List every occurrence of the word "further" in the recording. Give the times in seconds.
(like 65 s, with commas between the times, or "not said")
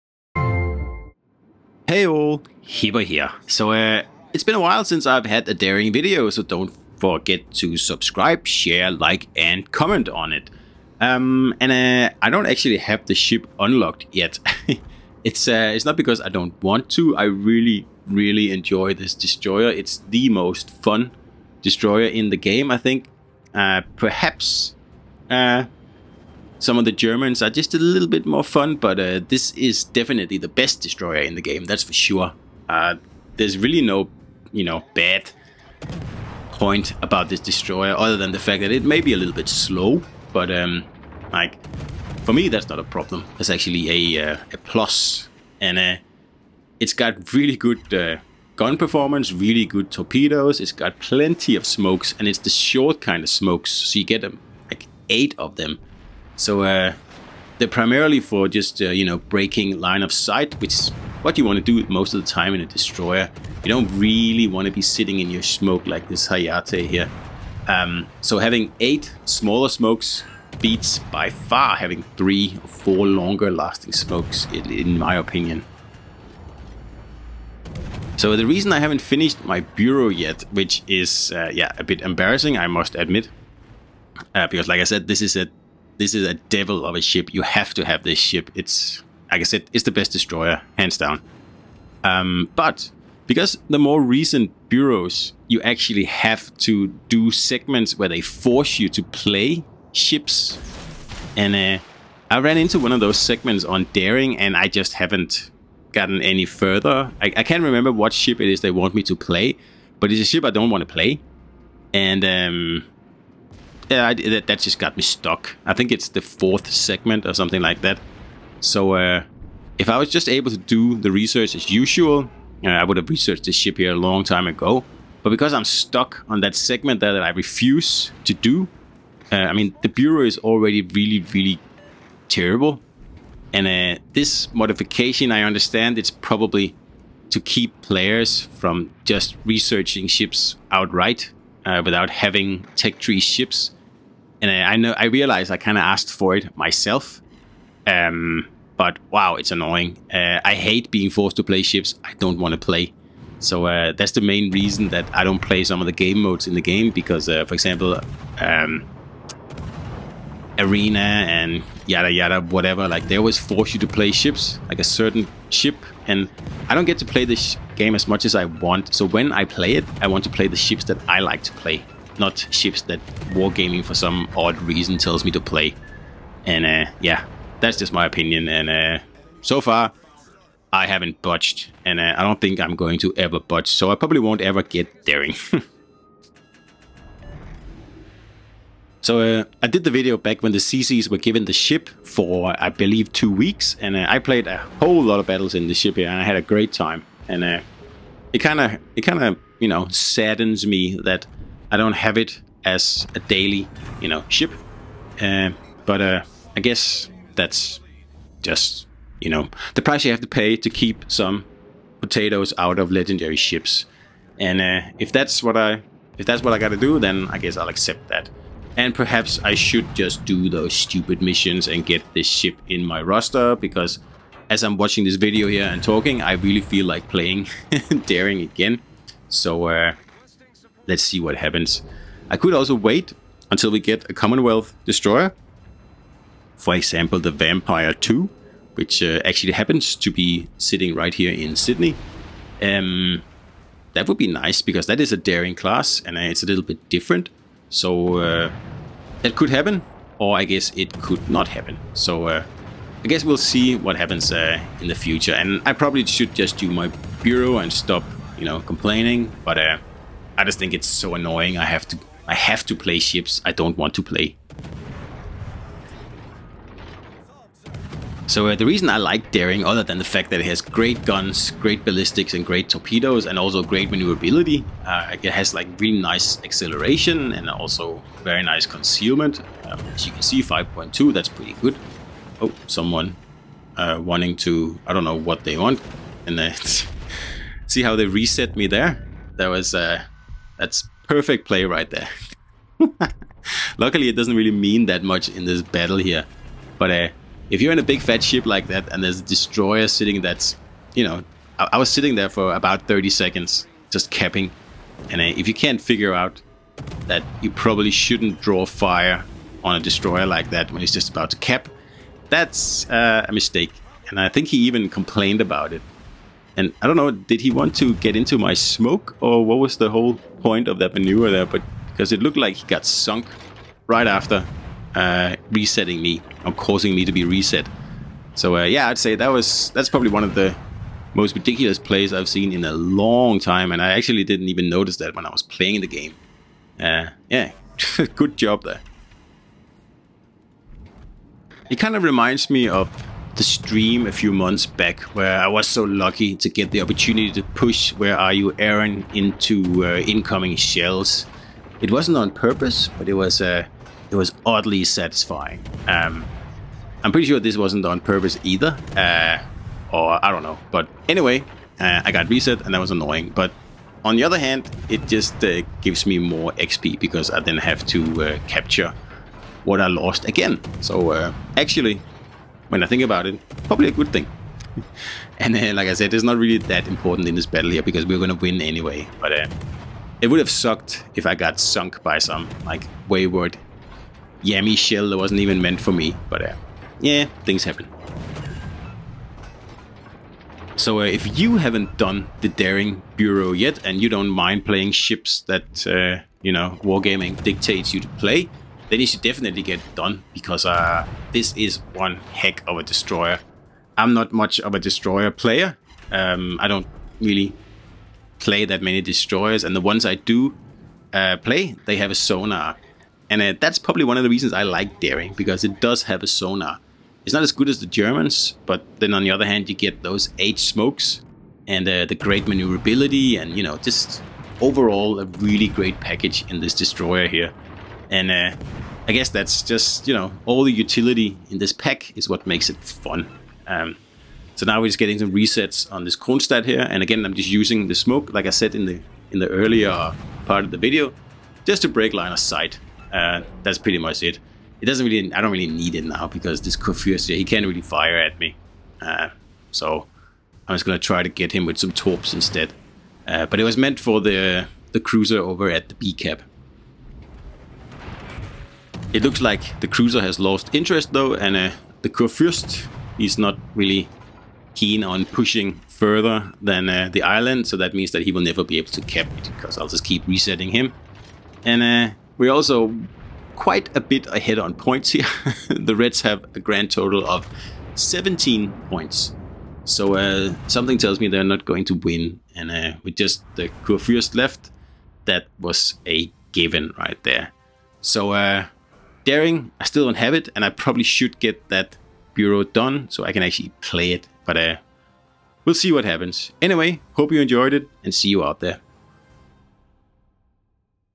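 106 s, 465 s.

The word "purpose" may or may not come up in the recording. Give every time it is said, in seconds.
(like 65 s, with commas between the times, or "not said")
352 s, 358 s.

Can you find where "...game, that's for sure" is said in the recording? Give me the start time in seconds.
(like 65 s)
31 s.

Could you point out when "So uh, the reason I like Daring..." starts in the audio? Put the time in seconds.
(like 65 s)
268 s.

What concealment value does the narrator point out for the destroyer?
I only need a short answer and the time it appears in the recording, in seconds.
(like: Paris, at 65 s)
5.2, at 280 s.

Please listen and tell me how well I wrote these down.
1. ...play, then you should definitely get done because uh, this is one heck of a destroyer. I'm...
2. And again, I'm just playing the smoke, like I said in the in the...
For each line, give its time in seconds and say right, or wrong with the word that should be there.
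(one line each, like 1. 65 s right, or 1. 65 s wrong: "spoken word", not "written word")
1. 398 s right
2. 436 s wrong: "using", not "playing".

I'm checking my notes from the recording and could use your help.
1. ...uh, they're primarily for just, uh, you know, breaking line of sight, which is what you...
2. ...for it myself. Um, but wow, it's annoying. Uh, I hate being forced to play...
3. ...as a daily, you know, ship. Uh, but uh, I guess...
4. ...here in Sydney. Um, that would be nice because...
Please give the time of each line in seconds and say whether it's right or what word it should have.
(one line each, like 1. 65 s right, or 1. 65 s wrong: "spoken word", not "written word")
1. 56 s right
2. 146 s right
3. 202 s right
4. 241 s right.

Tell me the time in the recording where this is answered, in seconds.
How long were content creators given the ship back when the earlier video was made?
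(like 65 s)
193 s.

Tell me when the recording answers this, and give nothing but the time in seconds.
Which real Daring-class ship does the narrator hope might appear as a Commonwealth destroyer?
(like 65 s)
237 s.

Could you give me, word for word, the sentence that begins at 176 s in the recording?
And uh, yeah, that's just my opinion.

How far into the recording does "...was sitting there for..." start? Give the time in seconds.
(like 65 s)
301 s.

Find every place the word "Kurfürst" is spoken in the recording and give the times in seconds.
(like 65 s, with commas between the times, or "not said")
446 s, 462 s, 483 s.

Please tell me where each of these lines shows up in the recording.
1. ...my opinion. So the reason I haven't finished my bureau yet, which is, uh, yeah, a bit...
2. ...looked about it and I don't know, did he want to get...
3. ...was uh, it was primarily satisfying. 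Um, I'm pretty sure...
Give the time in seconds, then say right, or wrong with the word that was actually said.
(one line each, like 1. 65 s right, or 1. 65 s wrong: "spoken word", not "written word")
1. 74 s right
2. 314 s wrong: "complained", not "looked"
3. 353 s wrong: "oddly", not "primarily".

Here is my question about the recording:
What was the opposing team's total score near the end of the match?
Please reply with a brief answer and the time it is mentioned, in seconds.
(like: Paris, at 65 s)
17, at 477 s.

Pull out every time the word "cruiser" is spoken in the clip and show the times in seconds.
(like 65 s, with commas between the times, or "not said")
455 s, 459 s.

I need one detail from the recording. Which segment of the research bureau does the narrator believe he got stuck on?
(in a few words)
The fourth.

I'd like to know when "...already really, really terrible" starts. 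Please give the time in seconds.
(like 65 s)
130 s.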